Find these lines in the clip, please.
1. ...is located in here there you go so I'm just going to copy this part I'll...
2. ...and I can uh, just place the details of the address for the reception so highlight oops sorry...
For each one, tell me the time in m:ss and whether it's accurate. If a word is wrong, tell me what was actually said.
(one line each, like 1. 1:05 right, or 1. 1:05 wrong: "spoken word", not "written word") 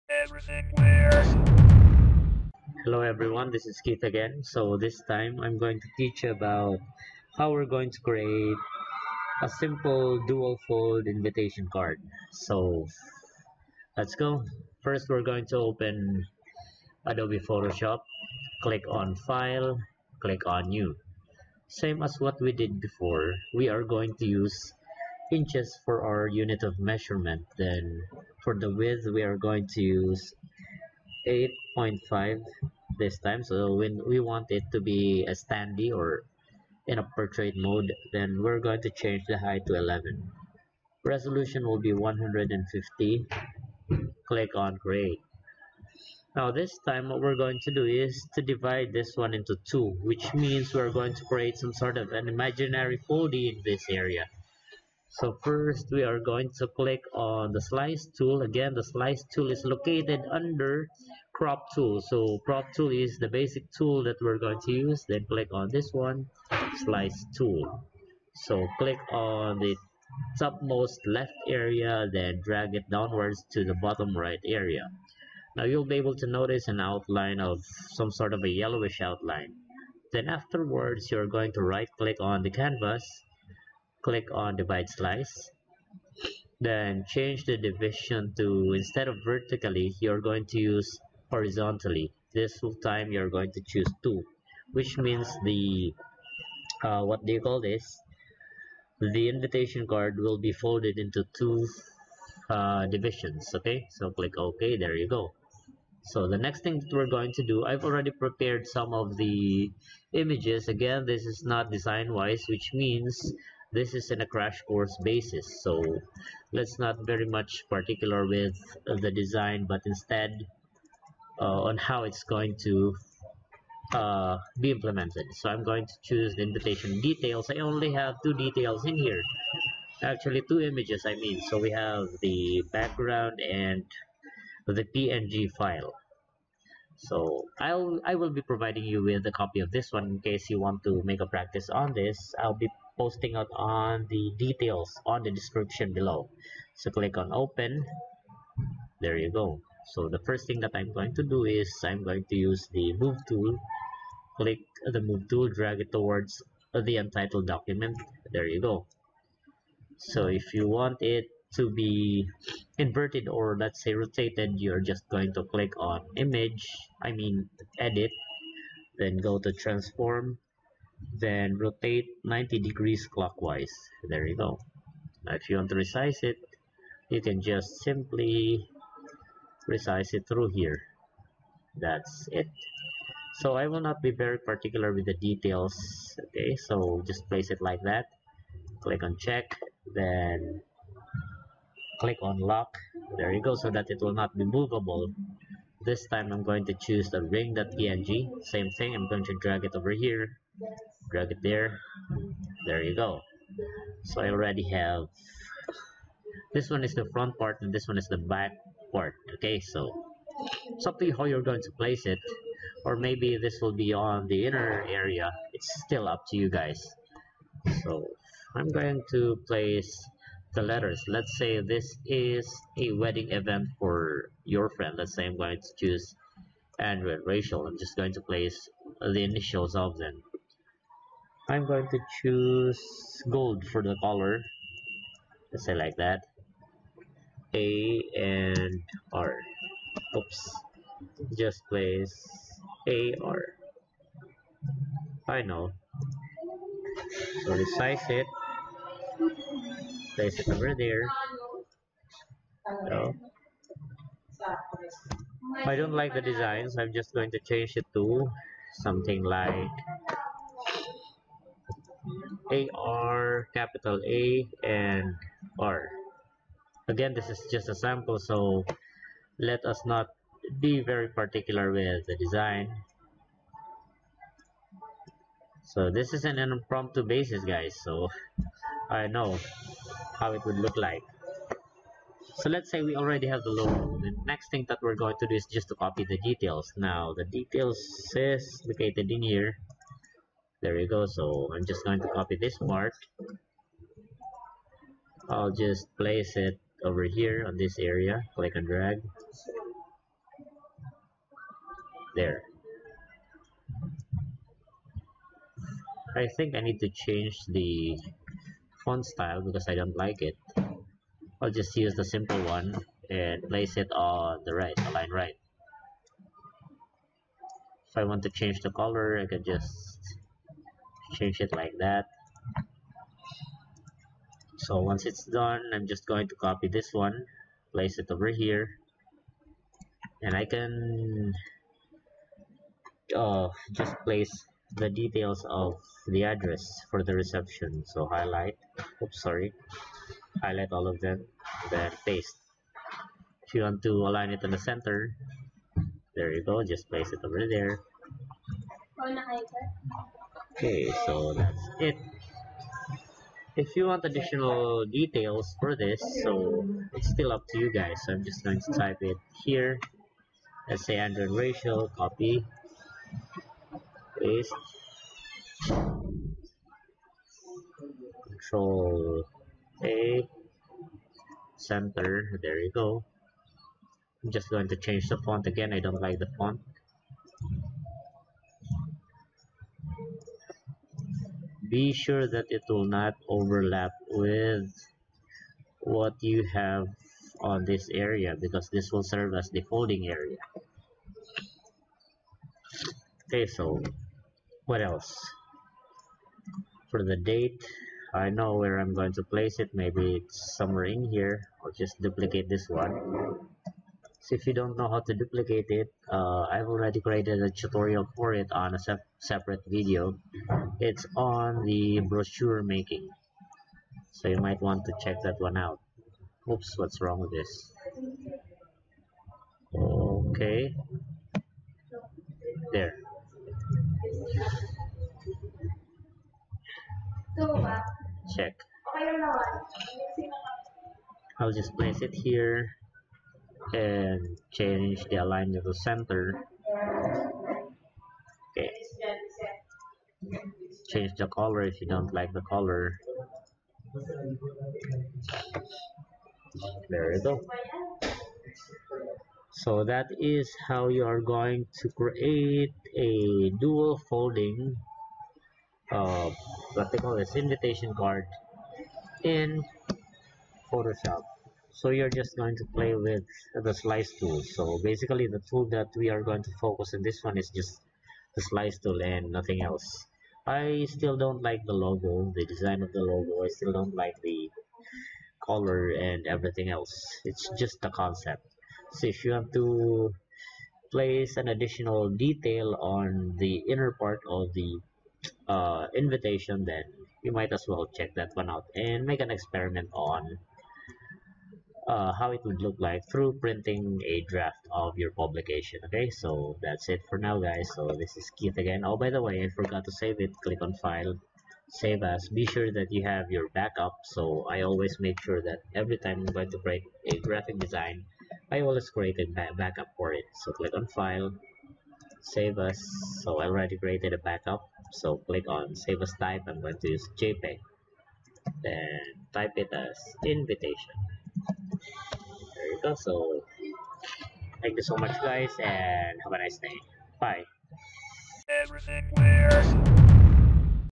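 1. 4:48 right
2. 5:30 right.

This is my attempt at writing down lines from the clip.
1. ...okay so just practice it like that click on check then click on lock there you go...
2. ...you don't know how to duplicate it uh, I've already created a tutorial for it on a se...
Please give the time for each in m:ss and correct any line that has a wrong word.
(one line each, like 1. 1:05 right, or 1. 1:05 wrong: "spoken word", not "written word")
1. 3:06 wrong: "place", not "practice"
2. 6:44 right.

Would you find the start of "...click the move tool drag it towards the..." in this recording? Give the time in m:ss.
2:34.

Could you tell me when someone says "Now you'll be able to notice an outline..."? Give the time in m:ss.
1:15.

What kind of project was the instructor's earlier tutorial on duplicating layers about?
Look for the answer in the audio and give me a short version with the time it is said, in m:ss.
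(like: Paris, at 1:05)
brochure making, at 6:51.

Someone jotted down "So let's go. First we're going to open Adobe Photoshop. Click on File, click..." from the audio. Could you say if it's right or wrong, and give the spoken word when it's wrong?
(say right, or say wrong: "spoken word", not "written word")
right.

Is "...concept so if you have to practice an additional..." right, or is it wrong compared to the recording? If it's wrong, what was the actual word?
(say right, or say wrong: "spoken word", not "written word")
wrong: "place", not "practice".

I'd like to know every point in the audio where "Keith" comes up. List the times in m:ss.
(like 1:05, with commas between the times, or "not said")
0:03, 8:18.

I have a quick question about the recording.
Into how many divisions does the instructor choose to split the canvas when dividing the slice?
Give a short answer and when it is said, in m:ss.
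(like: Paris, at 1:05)
2, at 1:34.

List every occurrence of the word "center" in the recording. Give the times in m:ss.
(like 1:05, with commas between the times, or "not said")
5:44, 6:11, 7:15.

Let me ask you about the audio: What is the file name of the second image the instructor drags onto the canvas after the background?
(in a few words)
ring.png.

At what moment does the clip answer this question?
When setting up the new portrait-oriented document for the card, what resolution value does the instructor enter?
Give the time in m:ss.
0:41.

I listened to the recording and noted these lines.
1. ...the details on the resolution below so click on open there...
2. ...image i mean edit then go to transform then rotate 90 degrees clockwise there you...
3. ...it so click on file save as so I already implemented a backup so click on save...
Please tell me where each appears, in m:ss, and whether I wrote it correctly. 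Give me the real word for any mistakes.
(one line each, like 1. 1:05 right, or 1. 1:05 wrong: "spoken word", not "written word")
1. 2:24 wrong: "description", not "resolution"
2. 2:46 right
3. 8:30 wrong: "created", not "implemented".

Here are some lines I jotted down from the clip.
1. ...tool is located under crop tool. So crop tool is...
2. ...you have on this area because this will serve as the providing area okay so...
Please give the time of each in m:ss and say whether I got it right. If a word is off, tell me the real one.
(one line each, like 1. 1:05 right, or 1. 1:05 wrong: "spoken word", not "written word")
1. 0:59 right
2. 6:26 wrong: "folding", not "providing".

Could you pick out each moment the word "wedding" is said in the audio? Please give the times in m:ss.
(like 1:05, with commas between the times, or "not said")
3:42.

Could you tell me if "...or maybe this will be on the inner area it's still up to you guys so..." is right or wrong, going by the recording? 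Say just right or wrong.
right.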